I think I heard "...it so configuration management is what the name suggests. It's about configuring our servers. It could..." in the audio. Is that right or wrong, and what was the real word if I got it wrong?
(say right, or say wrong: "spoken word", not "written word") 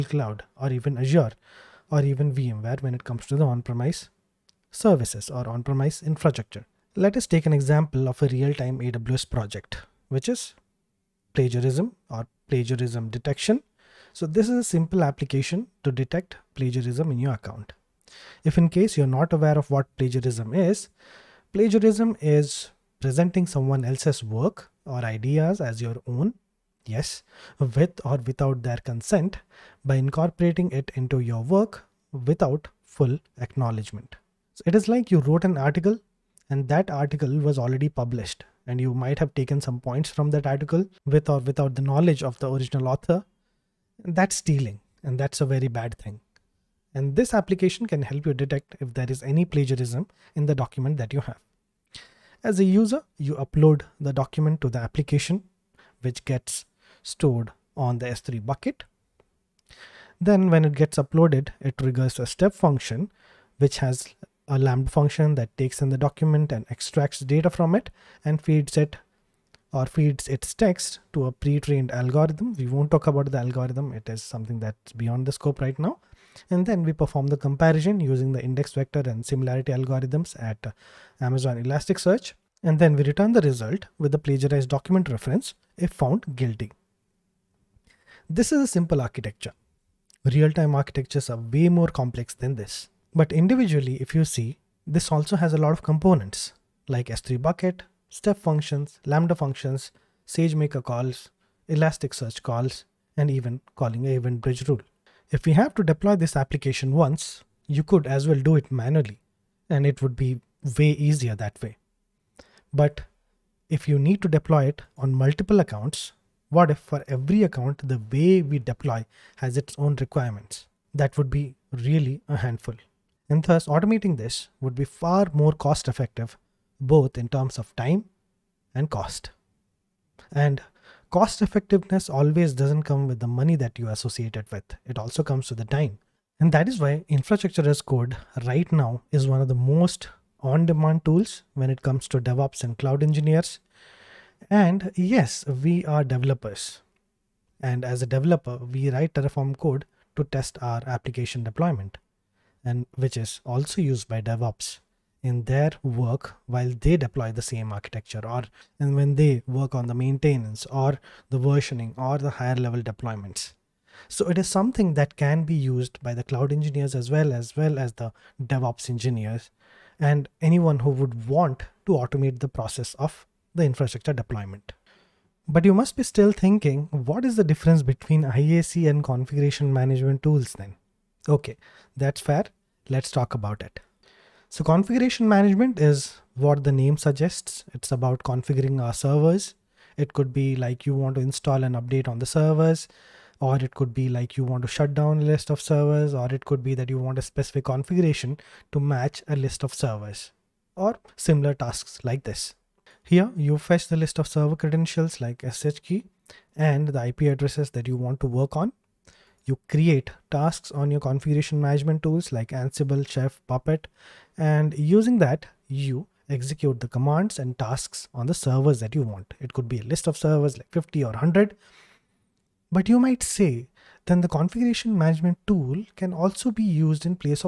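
right.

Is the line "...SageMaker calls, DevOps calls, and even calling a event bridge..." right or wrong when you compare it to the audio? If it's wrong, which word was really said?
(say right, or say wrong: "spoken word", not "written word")
wrong: "Elasticsearch", not "DevOps".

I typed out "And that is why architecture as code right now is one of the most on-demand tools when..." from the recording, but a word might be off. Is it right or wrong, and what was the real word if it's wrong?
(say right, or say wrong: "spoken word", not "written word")
wrong: "infrastructure", not "architecture".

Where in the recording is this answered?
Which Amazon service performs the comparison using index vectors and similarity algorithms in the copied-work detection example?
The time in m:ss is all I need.
1:21.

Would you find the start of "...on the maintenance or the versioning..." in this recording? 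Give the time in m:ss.
2:39.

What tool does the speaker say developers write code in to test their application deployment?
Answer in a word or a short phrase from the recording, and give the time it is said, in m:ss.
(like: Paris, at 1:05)
Terraform, at 2:29.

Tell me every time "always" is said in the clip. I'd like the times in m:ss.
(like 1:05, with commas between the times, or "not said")
2:12.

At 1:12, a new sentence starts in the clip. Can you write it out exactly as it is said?
We won't talk about the algorithm.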